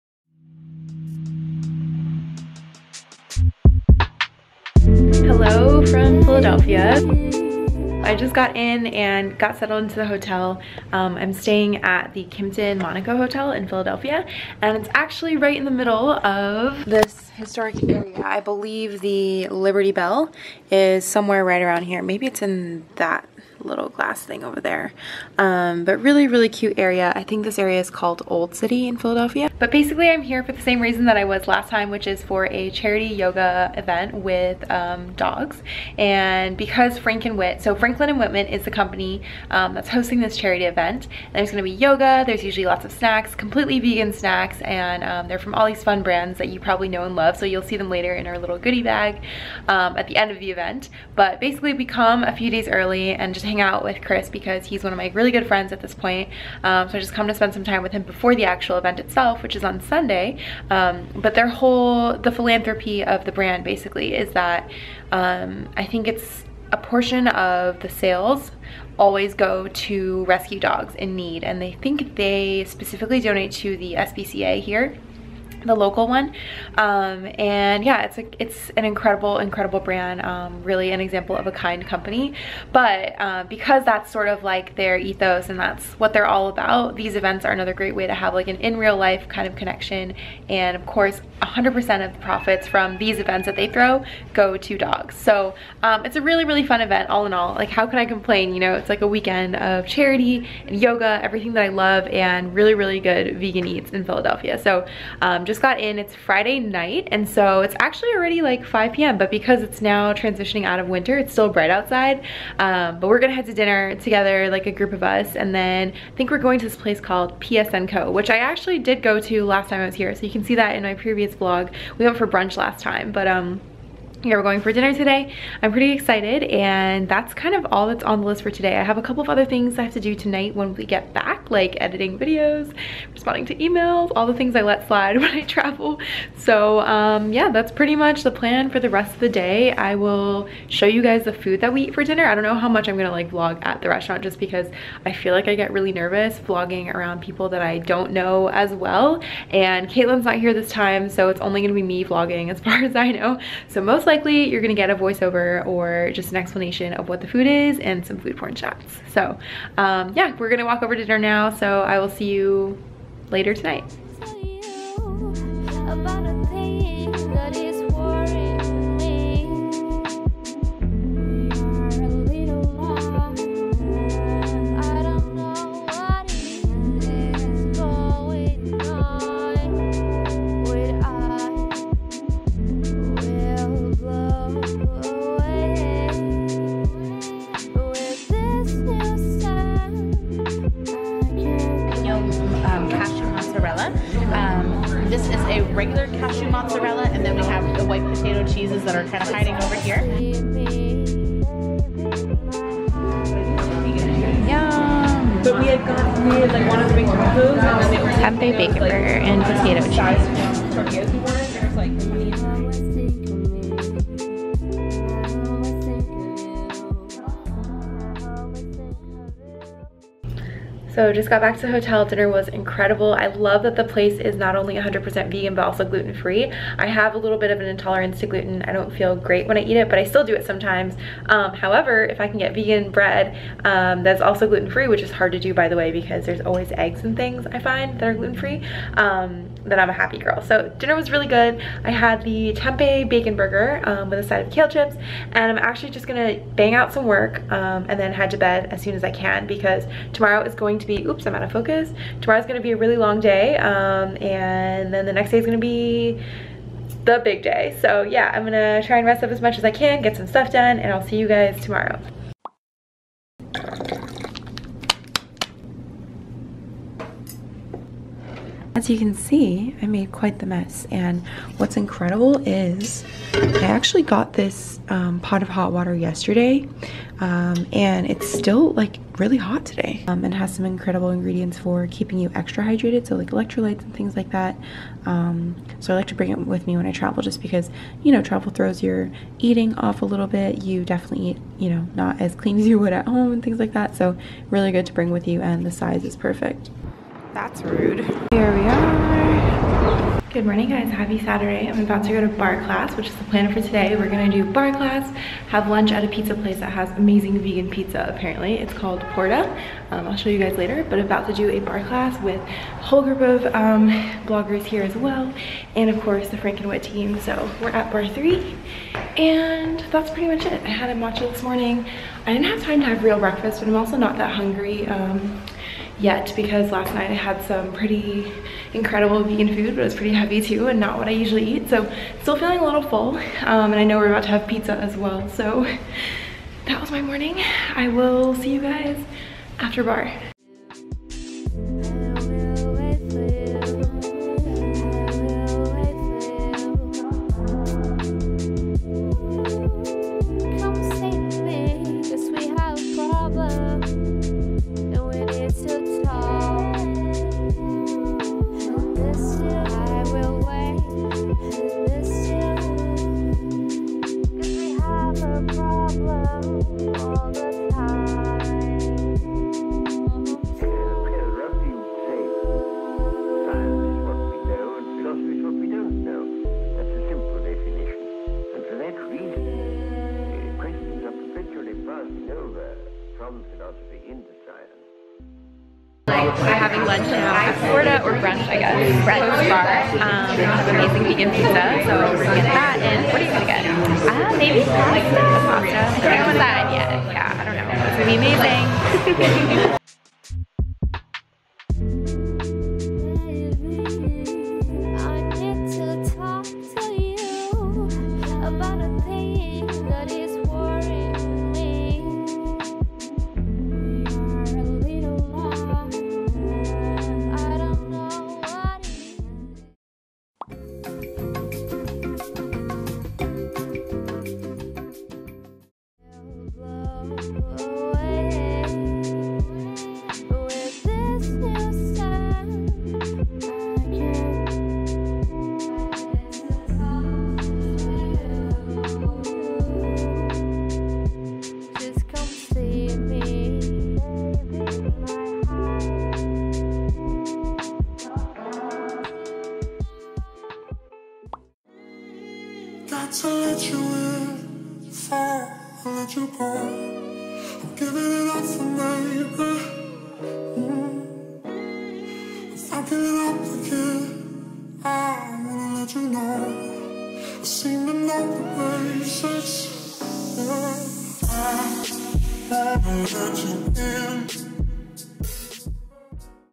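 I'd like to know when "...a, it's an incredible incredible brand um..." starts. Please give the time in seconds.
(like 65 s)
78 s.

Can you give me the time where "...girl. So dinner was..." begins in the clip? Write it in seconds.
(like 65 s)
240 s.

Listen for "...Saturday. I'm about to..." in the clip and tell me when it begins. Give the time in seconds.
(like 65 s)
301 s.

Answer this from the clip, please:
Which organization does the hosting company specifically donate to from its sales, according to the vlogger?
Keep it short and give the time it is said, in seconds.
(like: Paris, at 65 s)
the SPCA, at 73 s.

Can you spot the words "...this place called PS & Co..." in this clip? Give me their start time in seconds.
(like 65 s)
116 s.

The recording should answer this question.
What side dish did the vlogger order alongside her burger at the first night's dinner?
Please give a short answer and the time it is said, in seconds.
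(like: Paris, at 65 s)
kale chips, at 244 s.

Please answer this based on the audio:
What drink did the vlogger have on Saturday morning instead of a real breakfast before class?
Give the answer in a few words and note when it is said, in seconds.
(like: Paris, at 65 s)
matcha, at 320 s.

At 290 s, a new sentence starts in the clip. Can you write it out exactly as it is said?
You definitely eat, you know, not as clean as you would at home and things like that.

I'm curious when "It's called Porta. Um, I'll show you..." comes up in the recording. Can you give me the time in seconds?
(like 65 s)
308 s.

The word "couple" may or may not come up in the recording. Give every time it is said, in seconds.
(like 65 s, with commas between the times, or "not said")
129 s.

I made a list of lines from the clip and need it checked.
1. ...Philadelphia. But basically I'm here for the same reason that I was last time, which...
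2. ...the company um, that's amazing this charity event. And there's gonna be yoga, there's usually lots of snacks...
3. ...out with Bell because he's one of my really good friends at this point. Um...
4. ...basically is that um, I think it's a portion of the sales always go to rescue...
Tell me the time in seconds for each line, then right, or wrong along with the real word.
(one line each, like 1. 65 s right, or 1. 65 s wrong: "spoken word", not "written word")
1. 28 s right
2. 38 s wrong: "hosting", not "amazing"
3. 53 s wrong: "Chris", not "Bell"
4. 63 s right.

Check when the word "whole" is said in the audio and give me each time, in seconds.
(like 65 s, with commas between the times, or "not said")
61 s, 312 s.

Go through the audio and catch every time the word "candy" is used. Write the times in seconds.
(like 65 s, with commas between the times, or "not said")
not said.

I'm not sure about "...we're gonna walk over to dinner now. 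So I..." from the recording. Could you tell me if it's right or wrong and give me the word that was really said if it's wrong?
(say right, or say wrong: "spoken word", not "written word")
right.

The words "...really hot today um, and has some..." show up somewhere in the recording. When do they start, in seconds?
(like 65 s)
279 s.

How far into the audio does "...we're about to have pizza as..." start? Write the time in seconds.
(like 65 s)
333 s.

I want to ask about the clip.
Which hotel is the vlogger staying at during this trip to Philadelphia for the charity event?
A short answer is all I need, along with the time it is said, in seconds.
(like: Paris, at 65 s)
Kimpton Monaco Hotel, at 12 s.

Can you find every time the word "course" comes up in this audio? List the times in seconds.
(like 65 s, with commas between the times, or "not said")
90 s, 316 s.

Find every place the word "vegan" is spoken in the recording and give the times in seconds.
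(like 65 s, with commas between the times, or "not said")
43 s, 103 s, 225 s, 232 s, 307 s, 329 s, 391 s.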